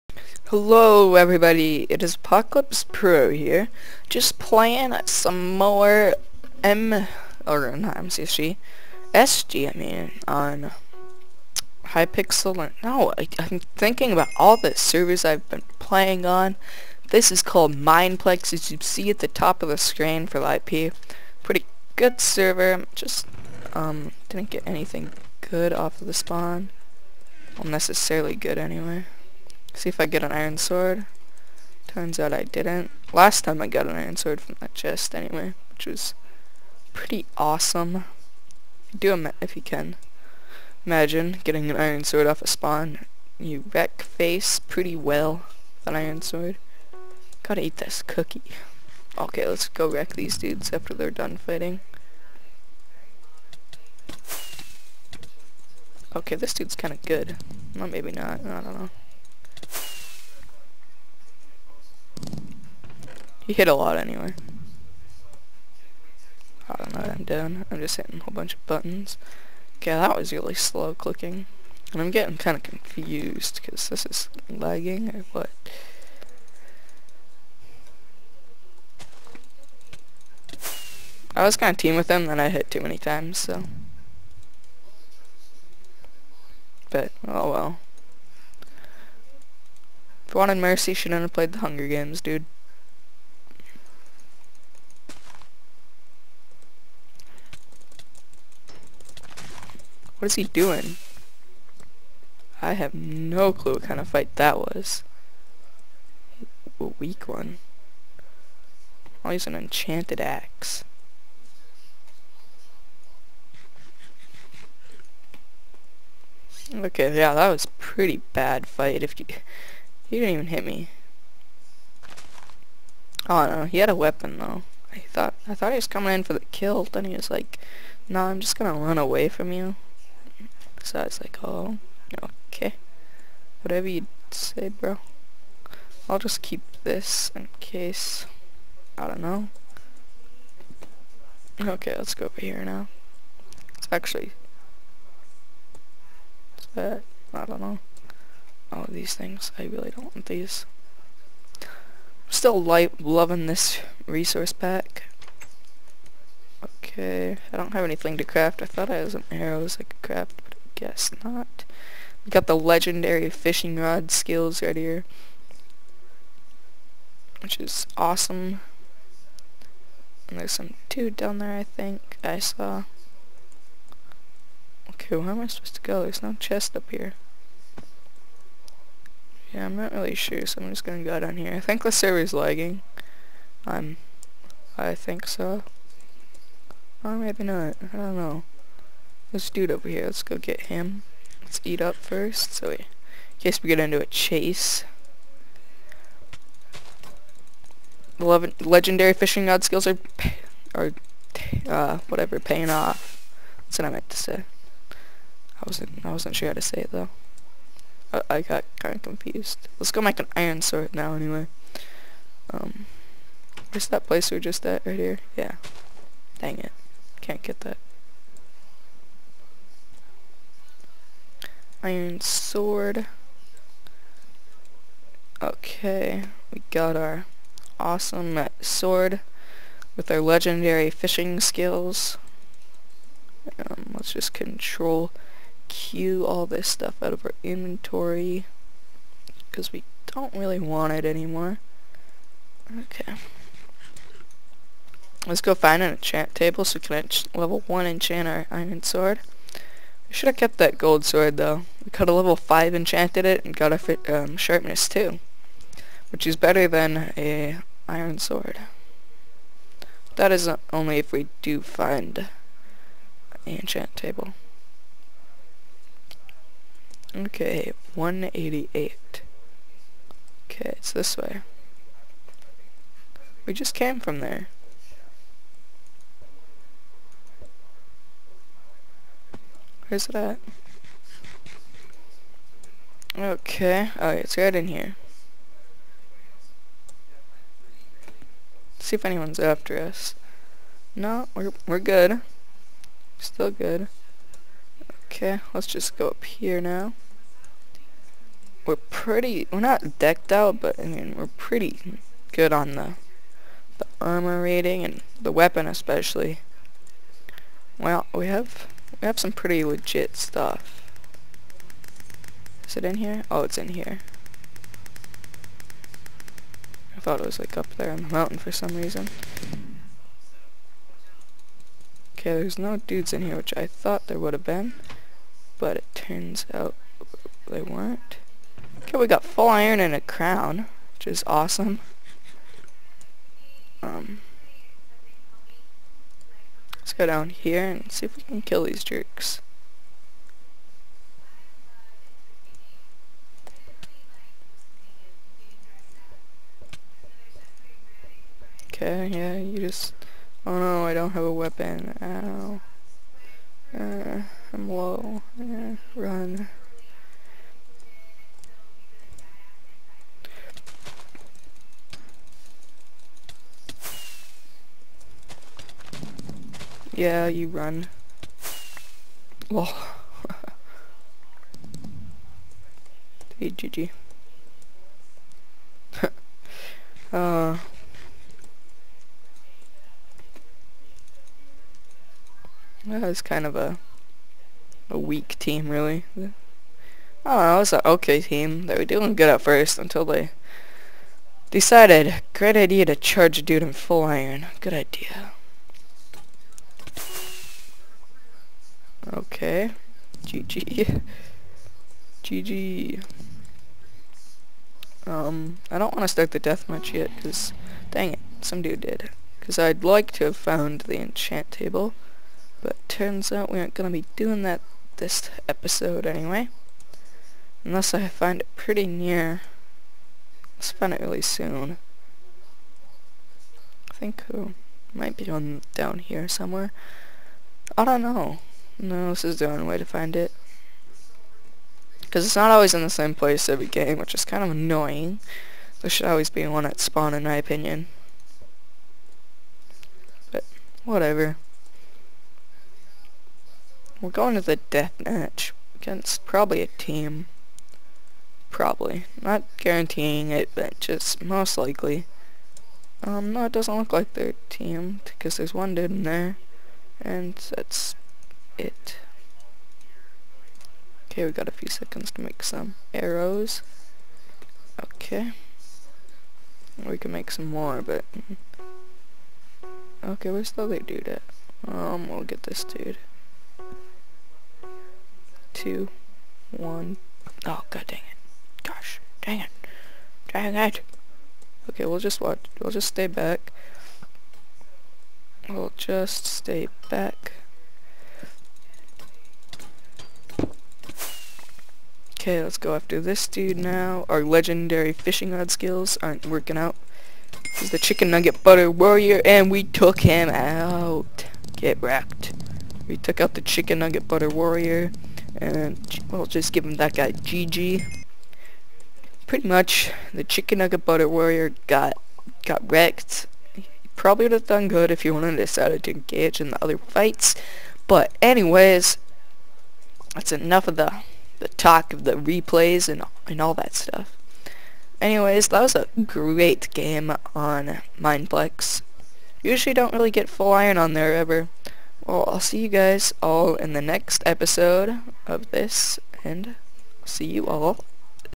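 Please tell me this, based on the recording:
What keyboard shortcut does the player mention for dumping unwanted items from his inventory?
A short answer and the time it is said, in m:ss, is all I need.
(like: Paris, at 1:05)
control Q, at 3:54.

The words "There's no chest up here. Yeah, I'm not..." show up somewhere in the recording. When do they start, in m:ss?
2:56.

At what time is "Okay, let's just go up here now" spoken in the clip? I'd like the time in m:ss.
4:55.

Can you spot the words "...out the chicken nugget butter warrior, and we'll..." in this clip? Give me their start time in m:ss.
8:23.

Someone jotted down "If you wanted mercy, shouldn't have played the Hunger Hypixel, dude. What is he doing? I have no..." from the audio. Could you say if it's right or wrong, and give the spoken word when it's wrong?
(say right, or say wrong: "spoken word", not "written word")
wrong: "Games", not "Hypixel".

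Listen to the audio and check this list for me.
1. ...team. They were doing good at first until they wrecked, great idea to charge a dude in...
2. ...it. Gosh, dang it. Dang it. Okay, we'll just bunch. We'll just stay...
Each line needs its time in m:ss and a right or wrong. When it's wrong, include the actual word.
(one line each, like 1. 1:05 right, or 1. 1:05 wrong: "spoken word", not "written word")
1. 6:28 wrong: "decided", not "wrecked"
2. 7:57 wrong: "watch", not "bunch".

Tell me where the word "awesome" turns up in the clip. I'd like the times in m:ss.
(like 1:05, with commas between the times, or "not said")
0:37, 2:47, 3:47, 5:31.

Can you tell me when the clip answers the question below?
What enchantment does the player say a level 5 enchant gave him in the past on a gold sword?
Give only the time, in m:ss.
4:14.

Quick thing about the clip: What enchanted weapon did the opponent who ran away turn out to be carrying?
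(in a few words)
enchanted axe.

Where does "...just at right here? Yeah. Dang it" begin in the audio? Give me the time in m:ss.
3:34.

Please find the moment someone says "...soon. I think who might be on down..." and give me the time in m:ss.
7:01.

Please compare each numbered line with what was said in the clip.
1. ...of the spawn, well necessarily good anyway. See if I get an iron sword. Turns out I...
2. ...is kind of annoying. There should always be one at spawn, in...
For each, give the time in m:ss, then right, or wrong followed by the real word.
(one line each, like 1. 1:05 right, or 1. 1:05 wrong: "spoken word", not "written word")
1. 0:26 right
2. 7:14 right.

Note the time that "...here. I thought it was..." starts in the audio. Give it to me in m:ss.
5:13.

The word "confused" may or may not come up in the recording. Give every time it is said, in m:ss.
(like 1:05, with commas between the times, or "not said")
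1:12, 3:29.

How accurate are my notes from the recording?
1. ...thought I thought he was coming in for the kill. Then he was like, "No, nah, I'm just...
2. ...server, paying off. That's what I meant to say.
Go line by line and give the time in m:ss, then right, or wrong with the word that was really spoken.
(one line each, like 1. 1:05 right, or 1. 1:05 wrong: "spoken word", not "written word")
1. 2:04 right
2. 3:22 wrong: "whatever", not "server".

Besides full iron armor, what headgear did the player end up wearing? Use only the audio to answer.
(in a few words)
a crown.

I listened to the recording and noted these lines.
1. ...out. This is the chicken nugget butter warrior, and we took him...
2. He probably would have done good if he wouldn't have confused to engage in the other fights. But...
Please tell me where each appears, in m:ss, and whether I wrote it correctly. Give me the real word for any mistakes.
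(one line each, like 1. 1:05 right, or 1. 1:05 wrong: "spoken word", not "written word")
1. 8:16 right
2. 8:33 wrong: "decided", not "confused".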